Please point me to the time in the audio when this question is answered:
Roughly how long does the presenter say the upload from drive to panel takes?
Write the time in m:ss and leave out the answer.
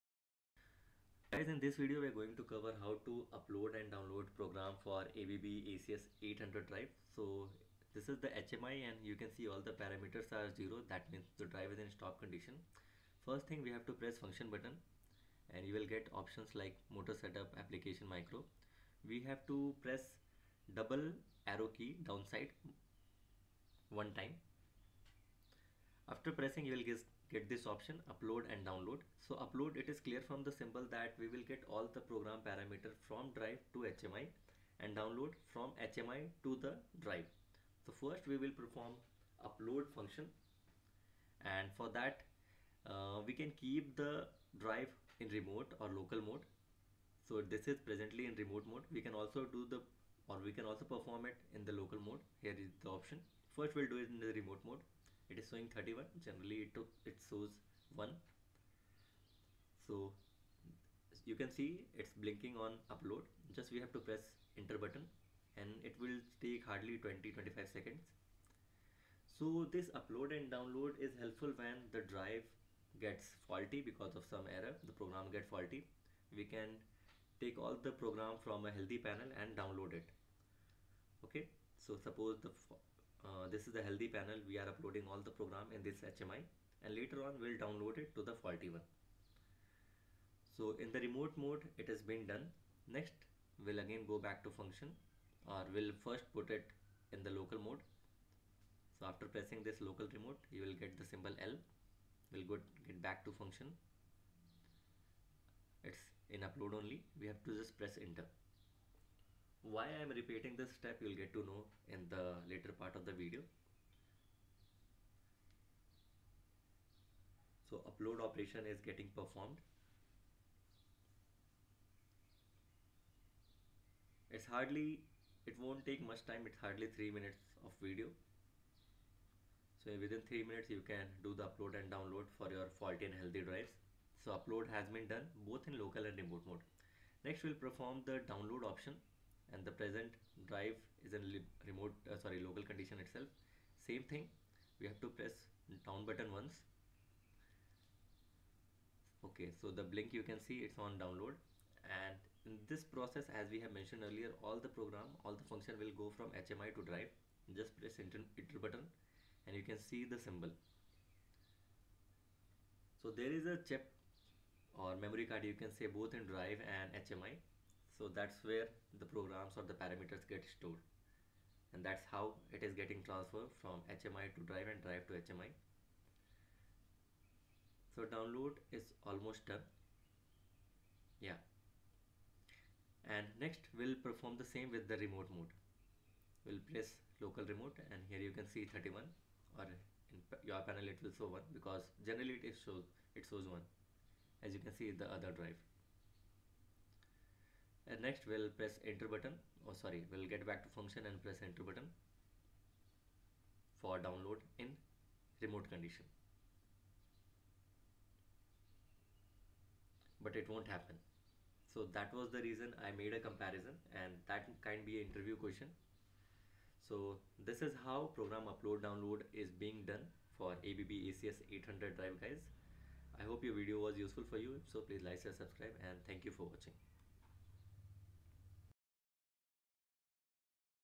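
1:07.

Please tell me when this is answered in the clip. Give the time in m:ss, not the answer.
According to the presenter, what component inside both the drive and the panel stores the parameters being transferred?
2:44.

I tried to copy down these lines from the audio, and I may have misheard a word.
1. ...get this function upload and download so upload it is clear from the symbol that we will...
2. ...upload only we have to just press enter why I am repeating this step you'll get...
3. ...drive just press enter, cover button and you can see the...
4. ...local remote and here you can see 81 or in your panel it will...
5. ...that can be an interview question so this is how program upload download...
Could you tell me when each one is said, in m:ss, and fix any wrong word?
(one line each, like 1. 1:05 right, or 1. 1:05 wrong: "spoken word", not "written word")
1. 0:27 wrong: "option", not "function"
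2. 1:46 right
3. 2:36 wrong: "enter", not "cover"
4. 3:07 wrong: "31", not "81"
5. 3:34 right.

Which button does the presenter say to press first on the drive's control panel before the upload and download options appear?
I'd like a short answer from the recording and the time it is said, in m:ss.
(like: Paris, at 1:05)
Function button, at 0:14.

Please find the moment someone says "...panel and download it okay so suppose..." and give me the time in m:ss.
1:19.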